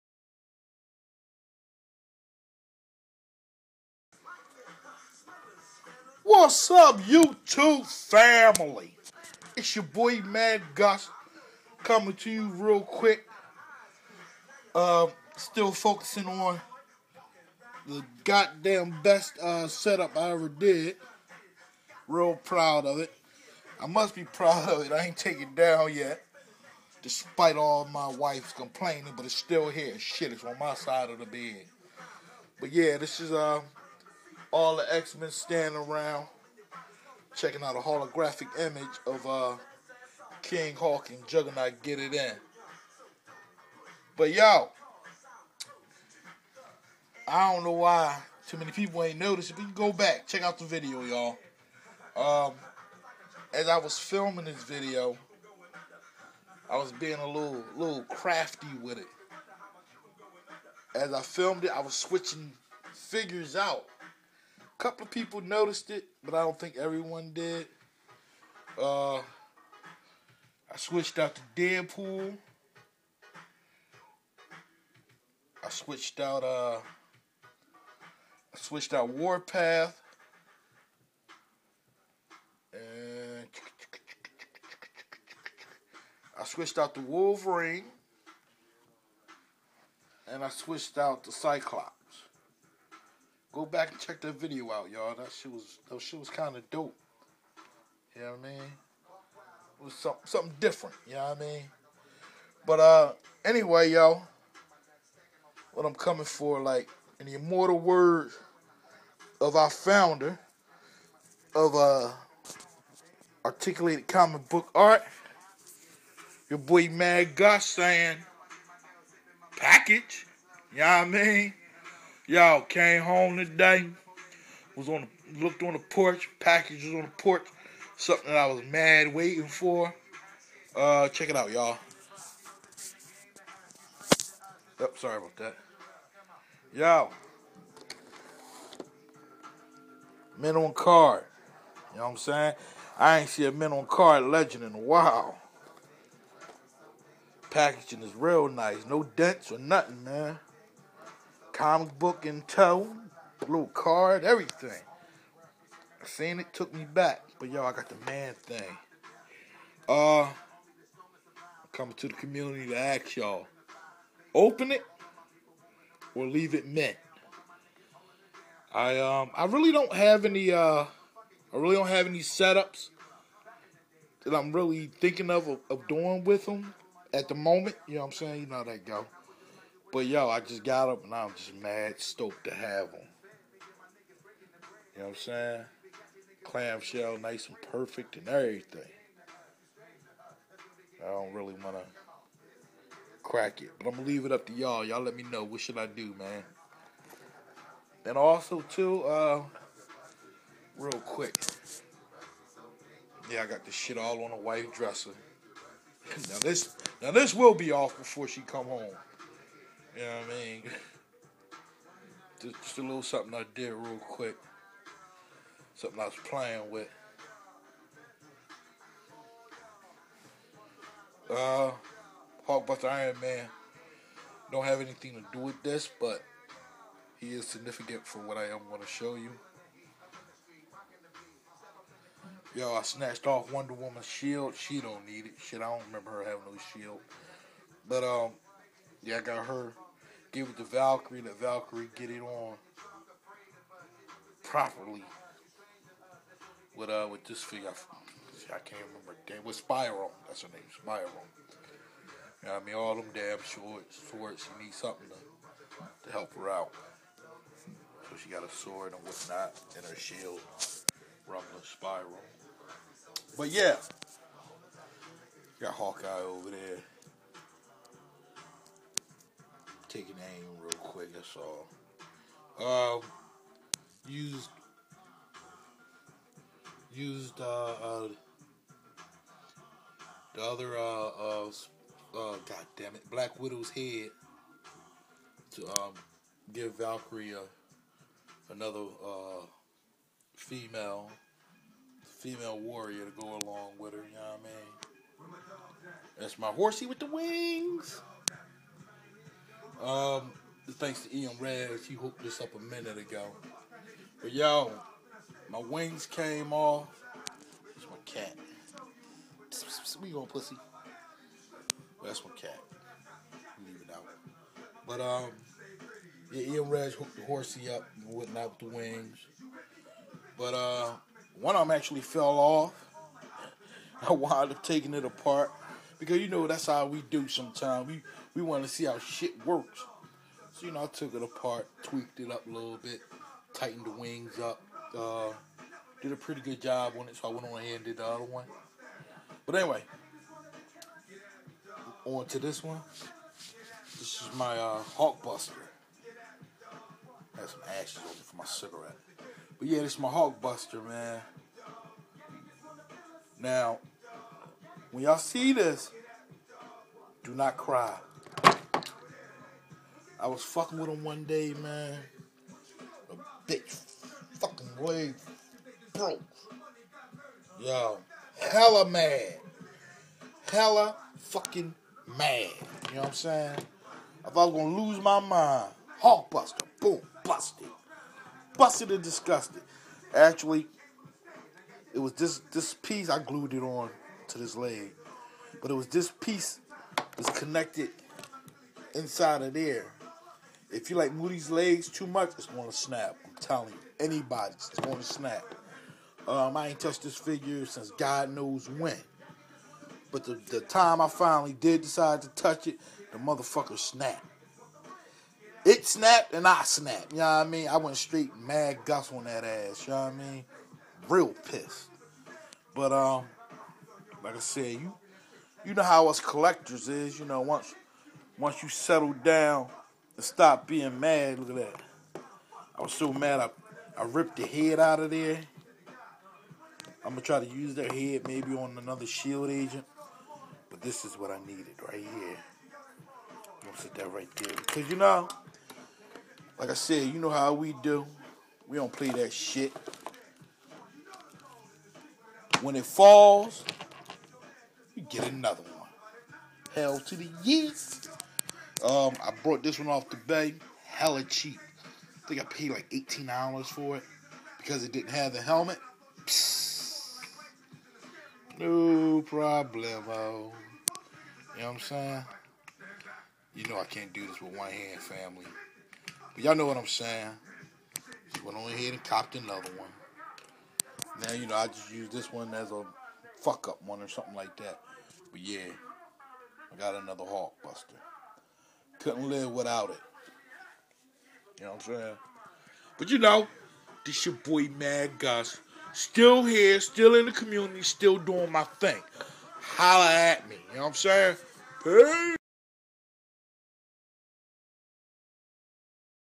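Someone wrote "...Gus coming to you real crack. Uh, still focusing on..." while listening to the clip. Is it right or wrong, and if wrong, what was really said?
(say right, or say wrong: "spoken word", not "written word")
wrong: "quick", not "crack".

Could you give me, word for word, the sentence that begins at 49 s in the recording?
But you go back, check out the video, y'all.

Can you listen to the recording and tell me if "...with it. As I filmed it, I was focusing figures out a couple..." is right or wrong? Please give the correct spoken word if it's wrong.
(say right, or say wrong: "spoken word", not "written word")
wrong: "switching", not "focusing".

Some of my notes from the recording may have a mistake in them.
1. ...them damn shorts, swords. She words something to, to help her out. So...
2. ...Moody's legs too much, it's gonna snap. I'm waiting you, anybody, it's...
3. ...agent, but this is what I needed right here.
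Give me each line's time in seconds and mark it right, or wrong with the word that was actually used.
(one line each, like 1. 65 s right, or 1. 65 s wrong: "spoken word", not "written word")
1. 252 s wrong: "needs", not "words"
2. 391 s wrong: "telling", not "waiting"
3. 429 s right.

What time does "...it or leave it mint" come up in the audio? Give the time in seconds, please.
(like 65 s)
164 s.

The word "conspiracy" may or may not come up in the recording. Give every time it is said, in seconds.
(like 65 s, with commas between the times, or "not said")
not said.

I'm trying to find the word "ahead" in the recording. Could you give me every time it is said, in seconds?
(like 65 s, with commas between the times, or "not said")
337 s, 468 s.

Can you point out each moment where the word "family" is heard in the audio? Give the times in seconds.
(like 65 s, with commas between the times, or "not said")
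7 s, 465 s.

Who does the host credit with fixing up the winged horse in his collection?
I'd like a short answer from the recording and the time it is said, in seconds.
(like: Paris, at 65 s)
Ian Reg, at 301 s.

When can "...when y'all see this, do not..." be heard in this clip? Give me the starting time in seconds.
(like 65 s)
354 s.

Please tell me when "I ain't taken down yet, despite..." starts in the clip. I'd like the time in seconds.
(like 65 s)
24 s.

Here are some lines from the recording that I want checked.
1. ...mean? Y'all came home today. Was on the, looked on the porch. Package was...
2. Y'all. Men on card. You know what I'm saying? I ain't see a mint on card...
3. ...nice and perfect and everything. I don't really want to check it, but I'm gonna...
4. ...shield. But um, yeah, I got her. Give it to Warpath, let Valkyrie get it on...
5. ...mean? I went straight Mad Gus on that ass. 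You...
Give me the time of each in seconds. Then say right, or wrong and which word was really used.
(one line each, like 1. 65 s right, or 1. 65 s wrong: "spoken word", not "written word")
1. 121 s right
2. 136 s right
3. 187 s wrong: "crack", not "check"
4. 236 s wrong: "Valkyrie", not "Warpath"
5. 407 s right.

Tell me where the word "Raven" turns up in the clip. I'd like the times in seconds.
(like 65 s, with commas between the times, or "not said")
not said.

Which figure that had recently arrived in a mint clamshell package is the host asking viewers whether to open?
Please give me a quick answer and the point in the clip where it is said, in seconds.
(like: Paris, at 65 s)
Man-Thing, at 158 s.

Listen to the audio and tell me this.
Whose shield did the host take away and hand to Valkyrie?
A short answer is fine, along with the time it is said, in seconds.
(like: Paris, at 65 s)
Wonder Woman, at 233 s.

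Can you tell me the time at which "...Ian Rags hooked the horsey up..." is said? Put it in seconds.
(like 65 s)
316 s.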